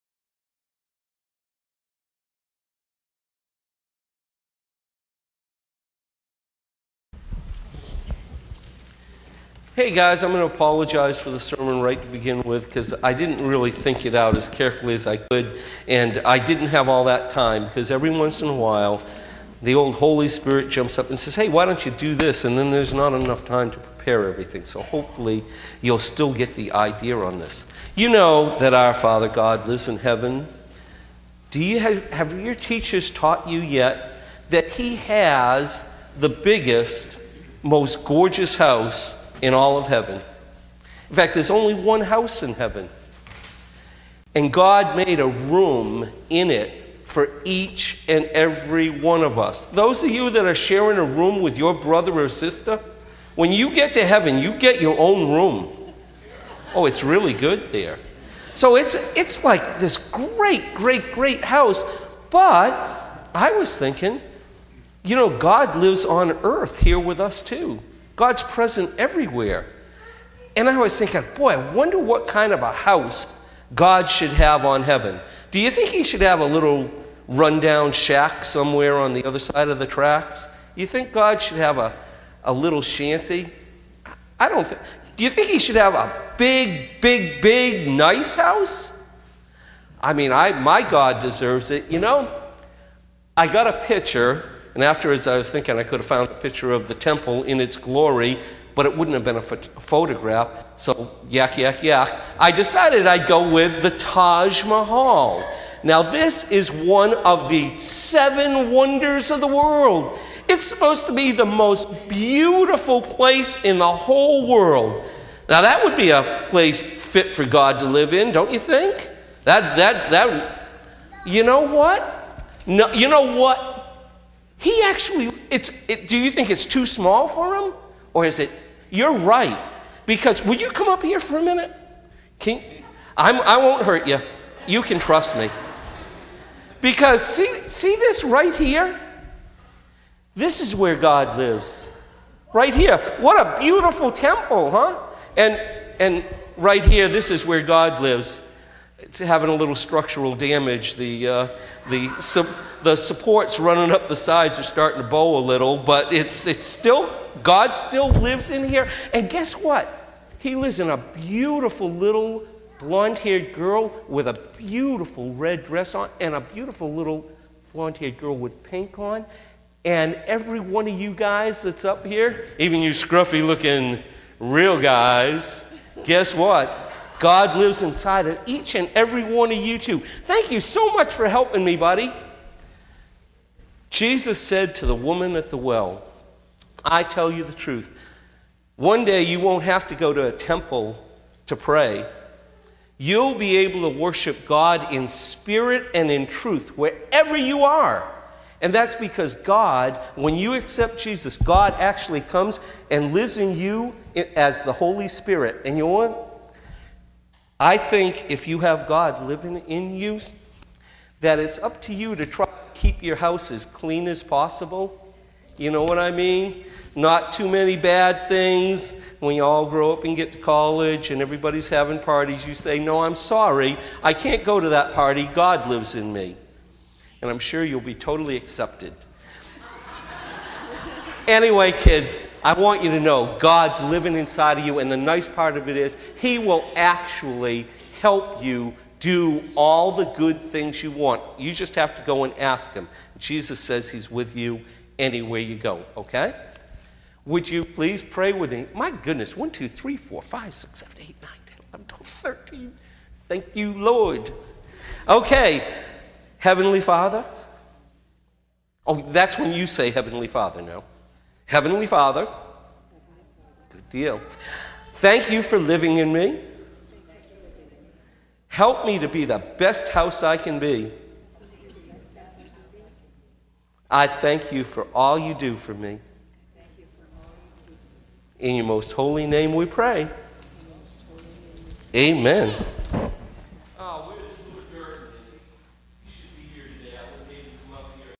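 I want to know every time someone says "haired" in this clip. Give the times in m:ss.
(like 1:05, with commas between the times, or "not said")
2:43, 2:47.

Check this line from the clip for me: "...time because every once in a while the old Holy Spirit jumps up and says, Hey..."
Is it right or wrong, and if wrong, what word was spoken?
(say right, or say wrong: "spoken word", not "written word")
right.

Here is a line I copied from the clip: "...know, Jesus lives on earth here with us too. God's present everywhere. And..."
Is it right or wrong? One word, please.
wrong.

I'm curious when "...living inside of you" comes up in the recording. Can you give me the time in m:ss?
3:53.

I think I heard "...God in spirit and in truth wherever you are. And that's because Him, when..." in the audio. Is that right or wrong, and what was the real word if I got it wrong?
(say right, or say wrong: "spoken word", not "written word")
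wrong: "God", not "Him".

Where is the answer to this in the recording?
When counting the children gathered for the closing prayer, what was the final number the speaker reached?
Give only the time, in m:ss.
4:12.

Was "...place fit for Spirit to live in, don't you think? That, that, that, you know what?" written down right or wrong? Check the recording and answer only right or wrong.
wrong.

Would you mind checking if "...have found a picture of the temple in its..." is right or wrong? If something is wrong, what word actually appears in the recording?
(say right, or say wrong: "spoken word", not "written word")
right.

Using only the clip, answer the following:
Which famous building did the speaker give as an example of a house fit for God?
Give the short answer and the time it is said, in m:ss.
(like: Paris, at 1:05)
Taj Mahal, at 1:43.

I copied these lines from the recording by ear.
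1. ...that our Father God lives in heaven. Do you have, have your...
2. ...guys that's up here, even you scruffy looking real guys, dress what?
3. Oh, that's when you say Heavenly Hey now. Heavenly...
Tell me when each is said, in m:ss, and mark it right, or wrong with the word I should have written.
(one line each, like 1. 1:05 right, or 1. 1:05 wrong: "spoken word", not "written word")
1. 0:28 right
2. 2:51 wrong: "guess", not "dress"
3. 4:18 wrong: "Father", not "Hey".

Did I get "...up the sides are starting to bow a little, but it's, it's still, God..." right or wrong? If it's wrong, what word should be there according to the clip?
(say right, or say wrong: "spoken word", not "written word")
right.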